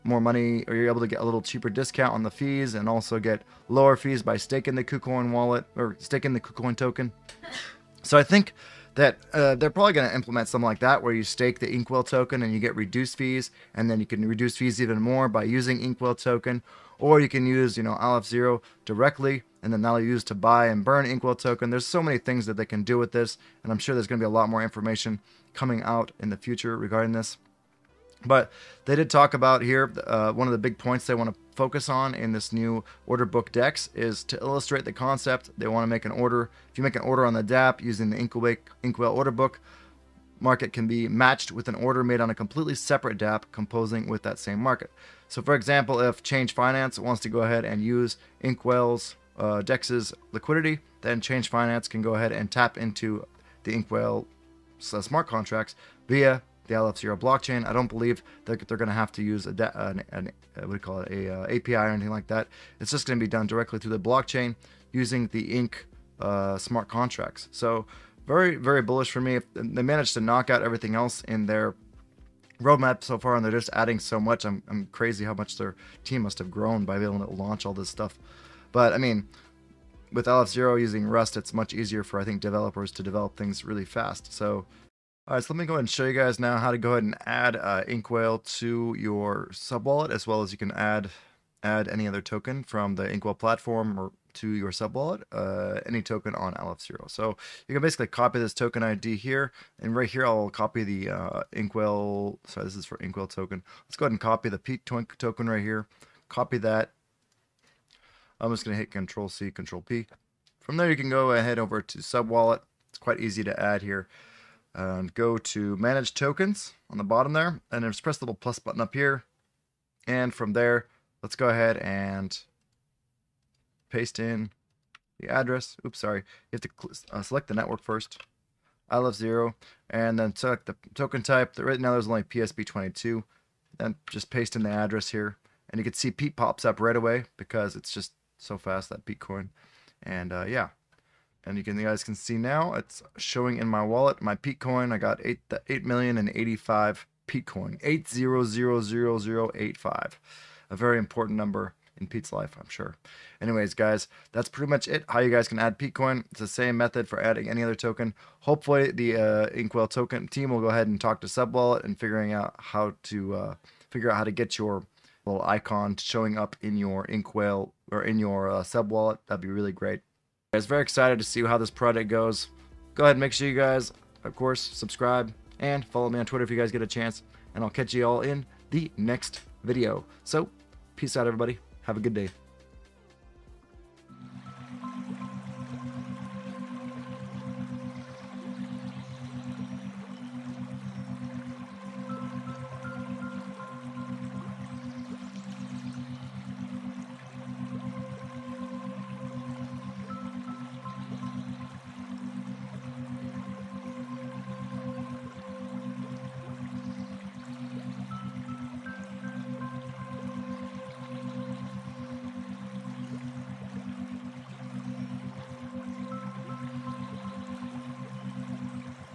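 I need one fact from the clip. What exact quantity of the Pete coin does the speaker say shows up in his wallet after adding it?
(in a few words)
8000085.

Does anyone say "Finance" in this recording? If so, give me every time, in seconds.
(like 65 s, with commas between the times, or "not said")
46 s, 51 s.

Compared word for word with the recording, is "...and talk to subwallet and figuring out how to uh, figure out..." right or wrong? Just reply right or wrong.
right.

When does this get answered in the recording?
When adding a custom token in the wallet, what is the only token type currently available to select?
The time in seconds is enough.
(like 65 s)
132 s.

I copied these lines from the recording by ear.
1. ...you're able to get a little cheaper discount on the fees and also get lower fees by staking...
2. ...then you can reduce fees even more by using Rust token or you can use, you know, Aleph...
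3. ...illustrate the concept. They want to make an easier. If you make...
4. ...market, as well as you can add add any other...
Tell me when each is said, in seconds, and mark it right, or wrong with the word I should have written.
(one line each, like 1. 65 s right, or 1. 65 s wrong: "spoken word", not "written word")
1. 0 s right
2. 13 s wrong: "Inkwhale", not "Rust"
3. 34 s wrong: "order", not "easier"
4. 89 s wrong: "subwallet", not "market".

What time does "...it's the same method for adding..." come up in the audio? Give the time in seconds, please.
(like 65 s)
156 s.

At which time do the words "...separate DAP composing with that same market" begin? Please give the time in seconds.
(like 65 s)
42 s.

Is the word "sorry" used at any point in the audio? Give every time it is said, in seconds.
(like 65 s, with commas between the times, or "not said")
102 s, 125 s.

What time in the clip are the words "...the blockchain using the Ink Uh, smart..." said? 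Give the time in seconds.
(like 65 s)
63 s.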